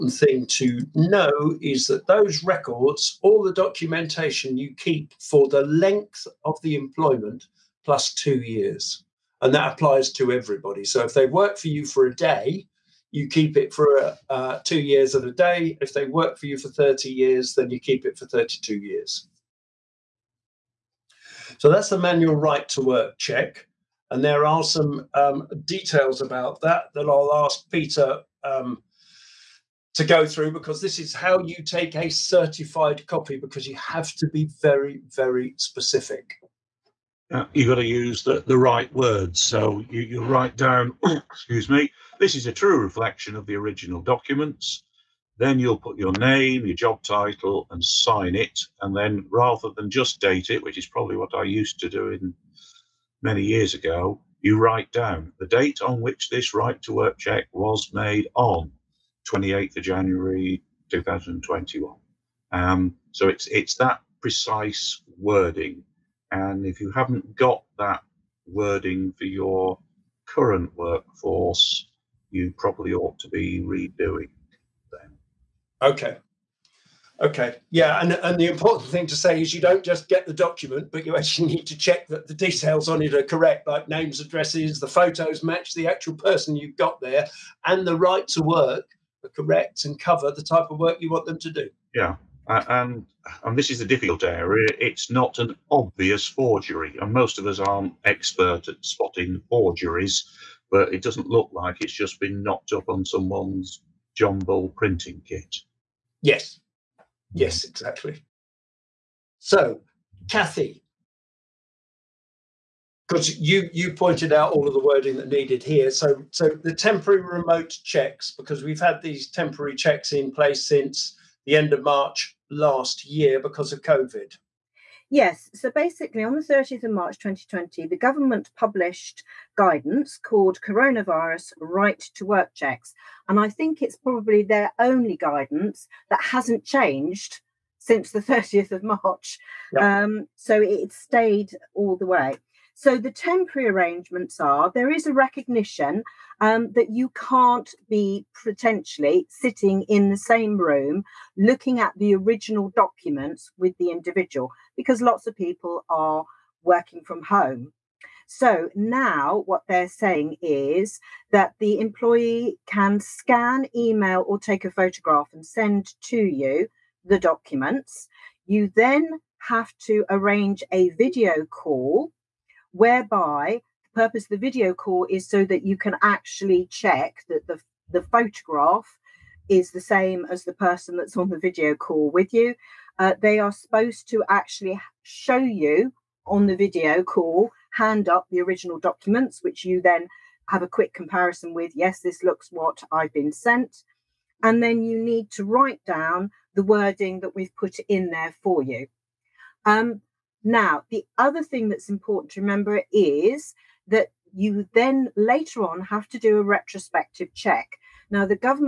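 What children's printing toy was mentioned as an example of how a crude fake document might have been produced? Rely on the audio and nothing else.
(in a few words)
John Bull printing kit.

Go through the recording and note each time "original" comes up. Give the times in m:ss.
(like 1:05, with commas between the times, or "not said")
0:43, 2:32, 3:08.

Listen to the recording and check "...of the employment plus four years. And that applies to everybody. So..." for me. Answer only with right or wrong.
wrong.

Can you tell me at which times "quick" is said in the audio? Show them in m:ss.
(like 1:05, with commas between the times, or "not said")
3:10.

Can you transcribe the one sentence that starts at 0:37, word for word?
Uh, you've got to use the, the right words.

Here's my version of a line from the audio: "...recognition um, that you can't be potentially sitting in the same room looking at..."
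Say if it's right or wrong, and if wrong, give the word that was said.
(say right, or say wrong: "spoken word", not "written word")
right.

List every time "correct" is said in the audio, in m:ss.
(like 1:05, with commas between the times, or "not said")
1:23, 1:29.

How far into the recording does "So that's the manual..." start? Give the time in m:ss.
0:21.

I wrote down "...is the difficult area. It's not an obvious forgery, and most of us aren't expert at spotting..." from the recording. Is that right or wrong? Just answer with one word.
right.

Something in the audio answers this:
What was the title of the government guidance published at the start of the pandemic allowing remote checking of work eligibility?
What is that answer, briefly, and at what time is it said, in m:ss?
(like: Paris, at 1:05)
Coronavirus Right to Work Checks, at 2:10.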